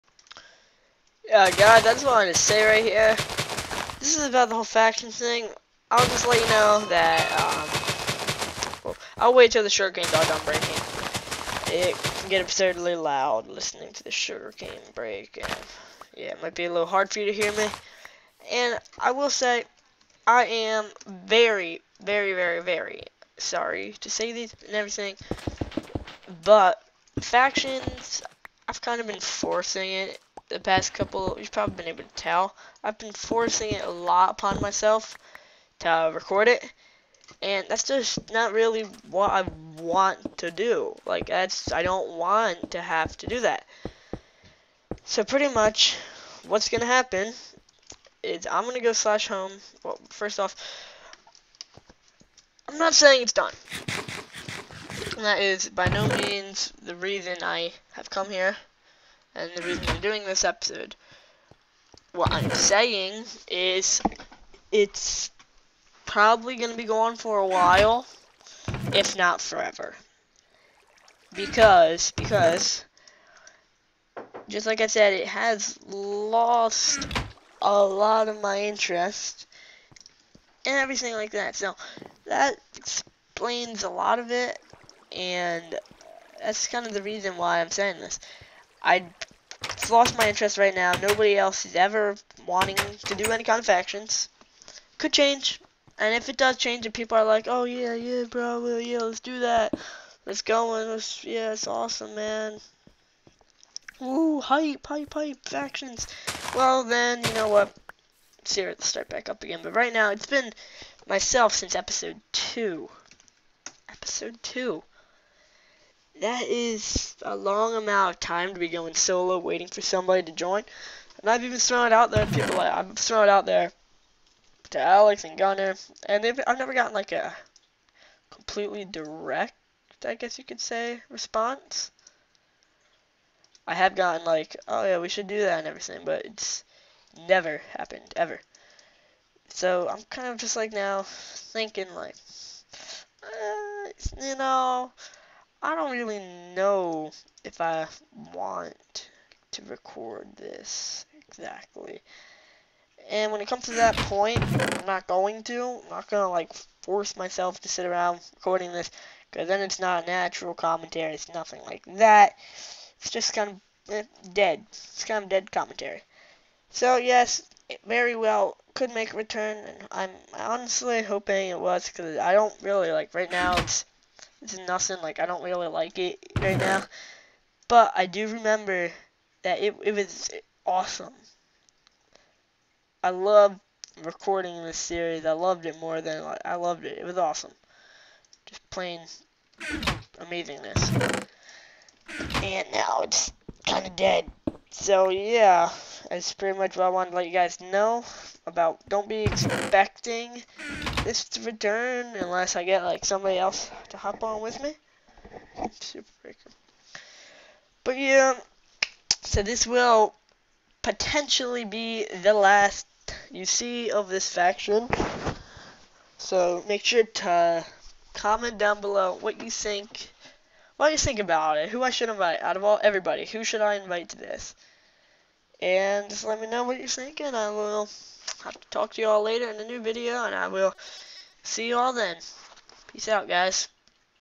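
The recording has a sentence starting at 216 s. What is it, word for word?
So make sure to comment down below what you think.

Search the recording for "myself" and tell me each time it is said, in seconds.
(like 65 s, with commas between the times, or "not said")
34 s, 111 s, 157 s.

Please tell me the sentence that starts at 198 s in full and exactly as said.
Don't be expecting this return unless I get like somebody else to hop on with me.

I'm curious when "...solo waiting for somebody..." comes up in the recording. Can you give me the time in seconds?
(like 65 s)
118 s.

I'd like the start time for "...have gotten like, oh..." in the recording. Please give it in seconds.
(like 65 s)
133 s.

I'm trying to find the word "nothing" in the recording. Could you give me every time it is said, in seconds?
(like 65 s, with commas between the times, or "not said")
161 s, 174 s.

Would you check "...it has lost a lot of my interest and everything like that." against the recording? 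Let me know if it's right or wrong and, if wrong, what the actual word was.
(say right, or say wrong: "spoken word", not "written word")
right.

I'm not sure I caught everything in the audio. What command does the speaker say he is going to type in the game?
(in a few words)
/home.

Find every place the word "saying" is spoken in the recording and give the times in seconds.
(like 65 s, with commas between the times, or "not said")
52 s, 62 s, 87 s.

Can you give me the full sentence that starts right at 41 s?
Like, that's, I don't want to have to do that.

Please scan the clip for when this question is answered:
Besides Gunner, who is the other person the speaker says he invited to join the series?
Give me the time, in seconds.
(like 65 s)
124 s.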